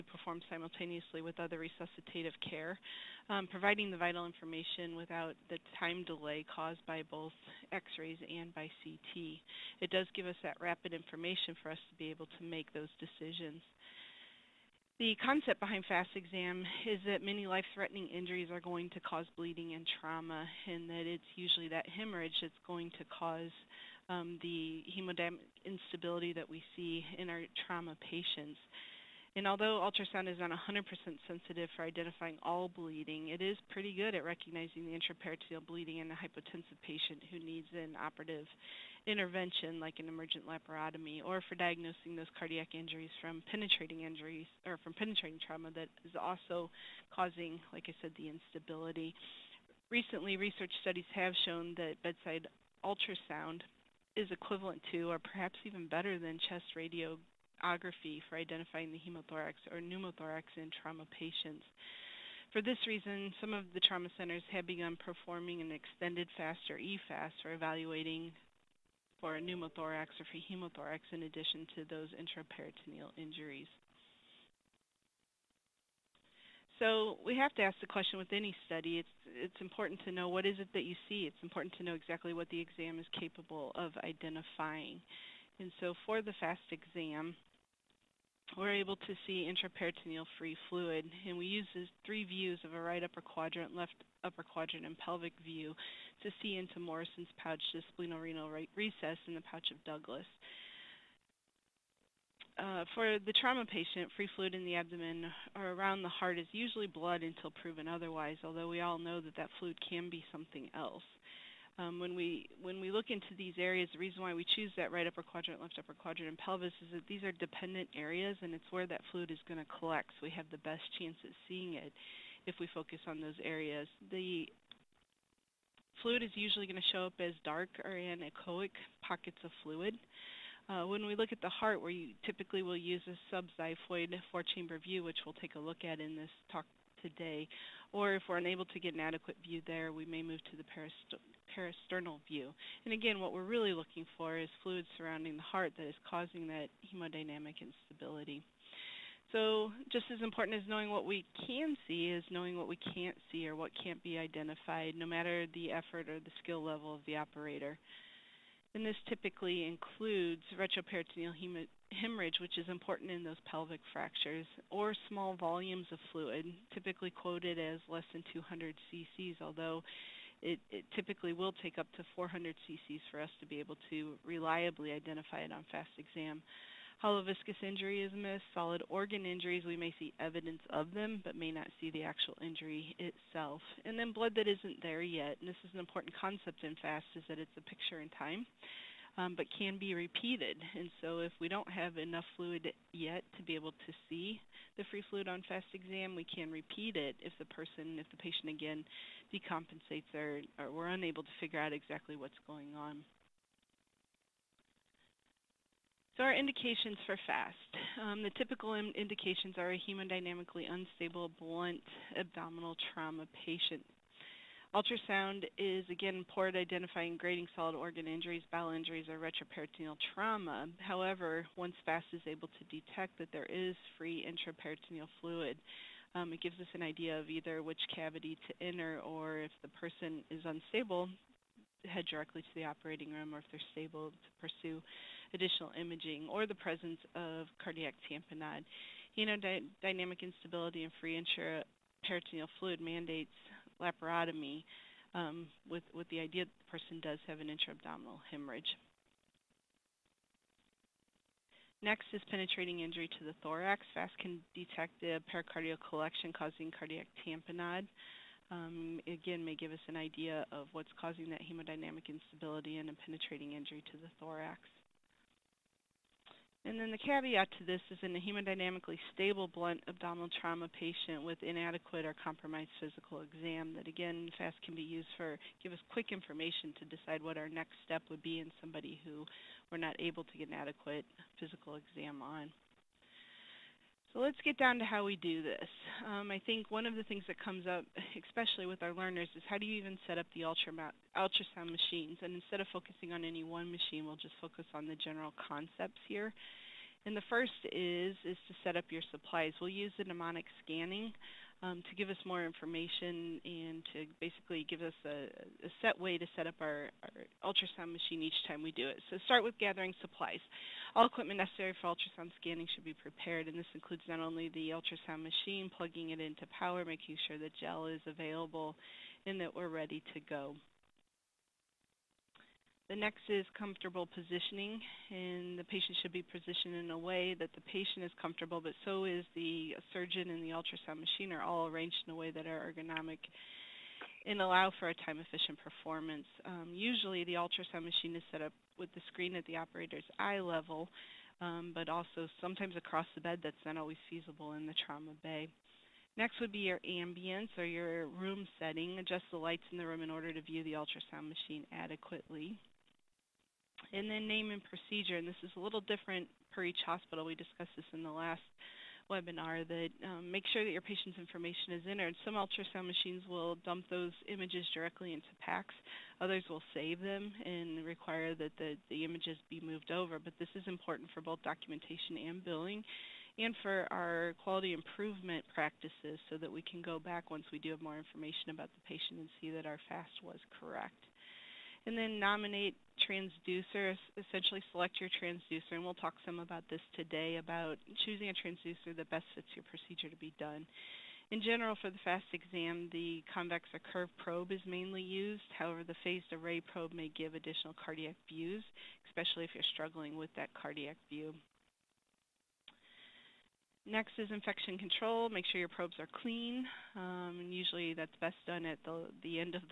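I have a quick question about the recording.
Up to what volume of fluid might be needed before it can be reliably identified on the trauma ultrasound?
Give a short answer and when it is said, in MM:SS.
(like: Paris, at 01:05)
400 cc, at 02:52.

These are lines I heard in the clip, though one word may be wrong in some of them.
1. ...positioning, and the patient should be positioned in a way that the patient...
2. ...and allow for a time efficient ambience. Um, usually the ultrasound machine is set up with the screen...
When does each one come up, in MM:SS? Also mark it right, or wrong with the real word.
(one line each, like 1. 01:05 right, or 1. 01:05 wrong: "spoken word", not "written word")
1. 05:24 right
2. 05:34 wrong: "performance", not "ambience".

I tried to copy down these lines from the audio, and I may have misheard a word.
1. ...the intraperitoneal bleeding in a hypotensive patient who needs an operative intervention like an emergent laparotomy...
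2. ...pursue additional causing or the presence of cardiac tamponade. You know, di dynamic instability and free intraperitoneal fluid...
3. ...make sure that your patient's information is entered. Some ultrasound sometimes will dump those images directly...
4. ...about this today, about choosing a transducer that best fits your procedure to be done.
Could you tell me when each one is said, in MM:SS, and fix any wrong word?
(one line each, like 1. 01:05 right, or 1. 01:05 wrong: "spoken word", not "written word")
1. 00:34 right
2. 03:54 wrong: "imaging", not "causing"
3. 06:00 wrong: "machines", not "sometimes"
4. 06:26 right.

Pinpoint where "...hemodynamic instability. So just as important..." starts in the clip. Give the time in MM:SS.
02:26.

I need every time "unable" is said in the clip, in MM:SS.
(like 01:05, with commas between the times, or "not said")
02:18, 03:20.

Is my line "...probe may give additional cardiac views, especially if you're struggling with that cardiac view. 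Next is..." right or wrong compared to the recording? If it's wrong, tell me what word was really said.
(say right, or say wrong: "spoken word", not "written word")
right.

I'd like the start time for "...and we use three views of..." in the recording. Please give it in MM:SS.
01:31.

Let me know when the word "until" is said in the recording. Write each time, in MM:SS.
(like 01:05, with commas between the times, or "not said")
01:47.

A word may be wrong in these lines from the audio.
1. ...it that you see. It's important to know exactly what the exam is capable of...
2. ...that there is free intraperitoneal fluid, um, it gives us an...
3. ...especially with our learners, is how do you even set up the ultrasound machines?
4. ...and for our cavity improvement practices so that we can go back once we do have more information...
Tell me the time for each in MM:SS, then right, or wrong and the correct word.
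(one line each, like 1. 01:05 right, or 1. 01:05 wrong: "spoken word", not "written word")
1. 01:20 right
2. 03:43 right
3. 04:48 right
4. 06:13 wrong: "quality", not "cavity".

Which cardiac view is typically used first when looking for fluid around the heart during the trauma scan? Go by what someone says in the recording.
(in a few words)
Subxiphoid four-chamber view.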